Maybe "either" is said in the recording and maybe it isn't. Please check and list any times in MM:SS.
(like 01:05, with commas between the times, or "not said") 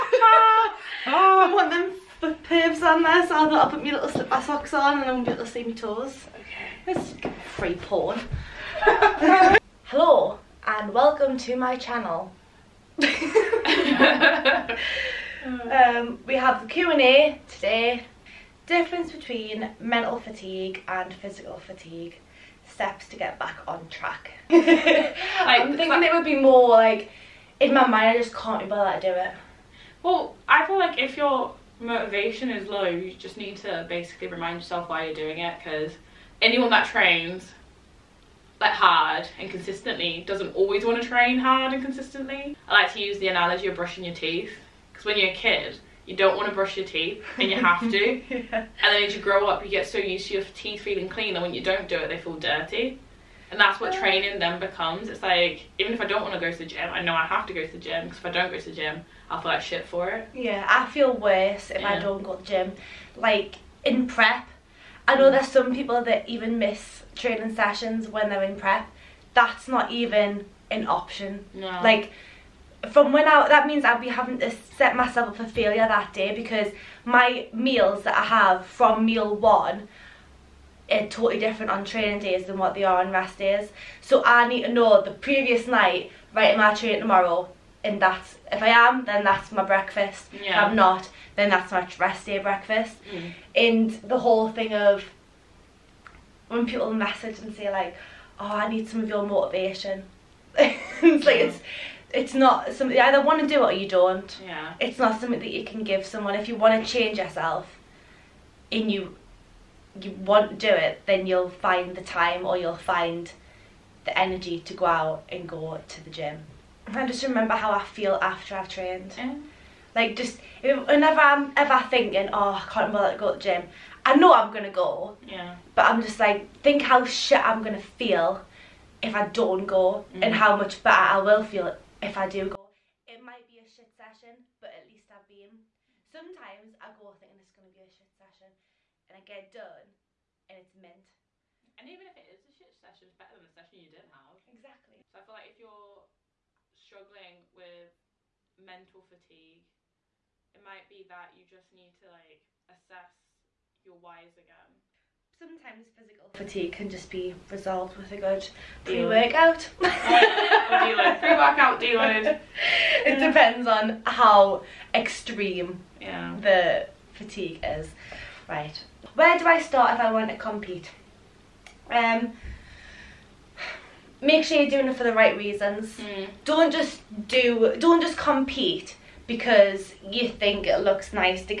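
01:43.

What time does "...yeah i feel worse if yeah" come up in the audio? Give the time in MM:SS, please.
01:00.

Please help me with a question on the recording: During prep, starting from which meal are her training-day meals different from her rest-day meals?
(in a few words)
meal one.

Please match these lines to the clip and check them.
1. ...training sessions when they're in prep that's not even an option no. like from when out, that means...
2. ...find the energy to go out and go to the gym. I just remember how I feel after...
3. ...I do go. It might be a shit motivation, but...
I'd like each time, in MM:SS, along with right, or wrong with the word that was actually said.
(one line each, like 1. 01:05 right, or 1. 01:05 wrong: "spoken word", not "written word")
1. 01:07 right
2. 01:52 right
3. 02:12 wrong: "session", not "motivation".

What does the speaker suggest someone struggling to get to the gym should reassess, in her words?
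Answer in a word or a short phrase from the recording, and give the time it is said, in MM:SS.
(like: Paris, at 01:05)
your whys, at 02:33.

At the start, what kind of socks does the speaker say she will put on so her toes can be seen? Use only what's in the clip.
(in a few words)
slip socks.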